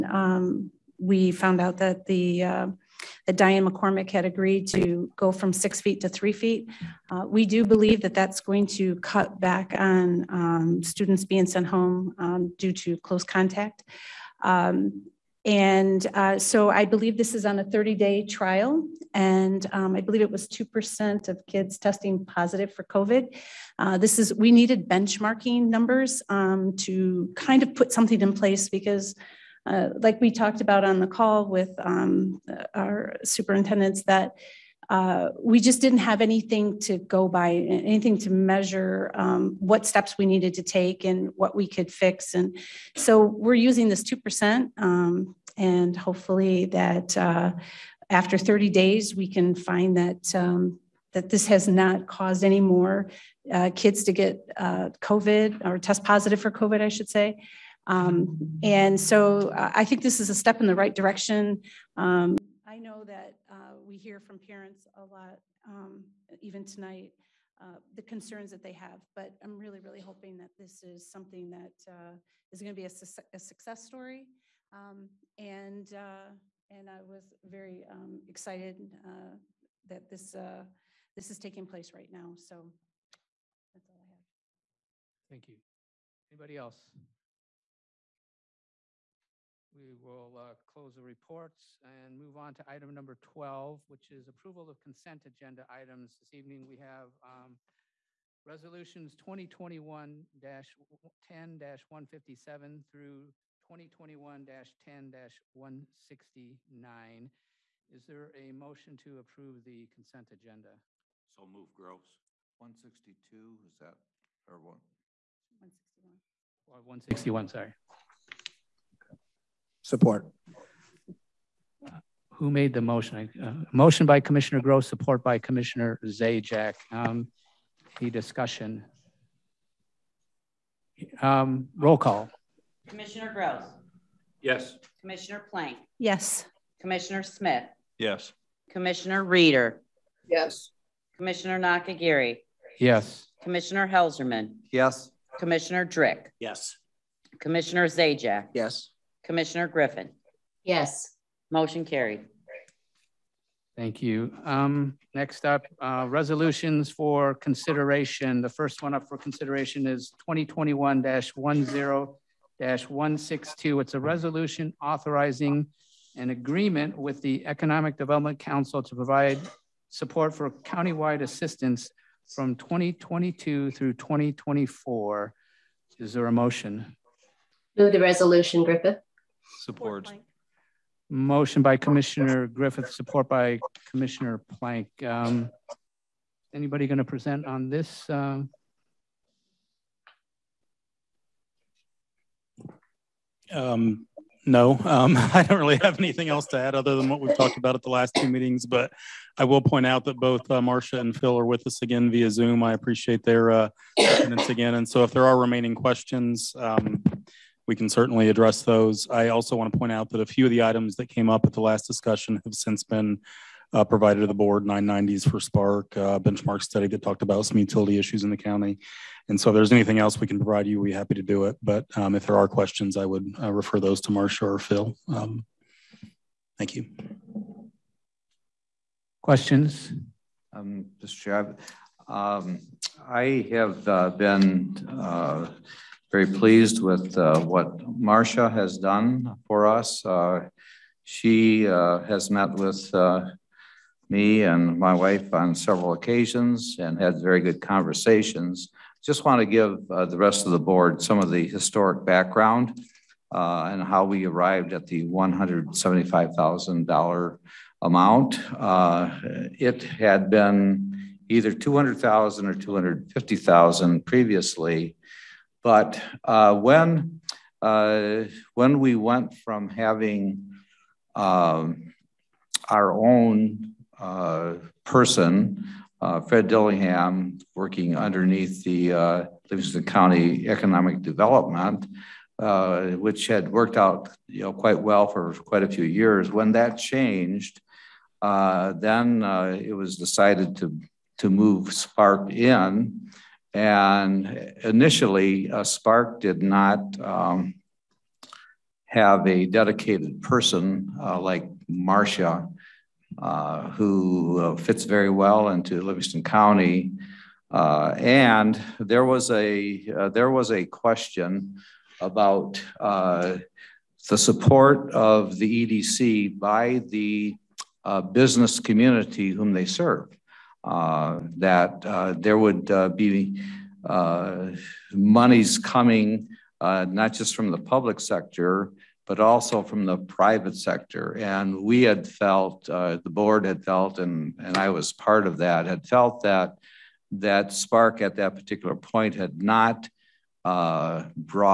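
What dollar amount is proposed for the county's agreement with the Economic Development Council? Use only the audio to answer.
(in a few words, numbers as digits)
$175,000.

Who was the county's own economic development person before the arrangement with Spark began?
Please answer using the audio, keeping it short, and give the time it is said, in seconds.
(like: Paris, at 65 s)
Fred Dillingham, at 276 s.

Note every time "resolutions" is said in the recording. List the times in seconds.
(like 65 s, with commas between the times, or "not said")
98 s, 156 s, 164 s, 177 s.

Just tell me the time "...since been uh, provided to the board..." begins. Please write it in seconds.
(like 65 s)
212 s.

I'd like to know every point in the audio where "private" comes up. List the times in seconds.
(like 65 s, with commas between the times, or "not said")
329 s.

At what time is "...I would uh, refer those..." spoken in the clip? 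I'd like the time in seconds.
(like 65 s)
222 s.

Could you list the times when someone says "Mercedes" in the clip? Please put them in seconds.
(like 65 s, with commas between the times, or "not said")
not said.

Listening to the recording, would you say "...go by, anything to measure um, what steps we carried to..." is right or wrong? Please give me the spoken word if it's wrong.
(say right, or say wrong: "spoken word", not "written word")
wrong: "needed", not "carried".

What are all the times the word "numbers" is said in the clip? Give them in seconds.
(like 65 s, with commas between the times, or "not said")
25 s, 92 s.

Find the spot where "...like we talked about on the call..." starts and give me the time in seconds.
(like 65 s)
30 s.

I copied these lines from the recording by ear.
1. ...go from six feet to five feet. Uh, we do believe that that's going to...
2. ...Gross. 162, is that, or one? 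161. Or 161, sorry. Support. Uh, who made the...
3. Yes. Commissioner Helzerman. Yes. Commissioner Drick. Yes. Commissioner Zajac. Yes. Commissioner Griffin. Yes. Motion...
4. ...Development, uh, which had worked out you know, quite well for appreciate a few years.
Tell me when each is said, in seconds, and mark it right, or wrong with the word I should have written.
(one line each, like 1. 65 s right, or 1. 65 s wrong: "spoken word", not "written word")
1. 5 s wrong: "three", not "five"
2. 111 s right
3. 142 s right
4. 281 s wrong: "quite", not "appreciate".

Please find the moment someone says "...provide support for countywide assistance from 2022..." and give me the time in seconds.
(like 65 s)
168 s.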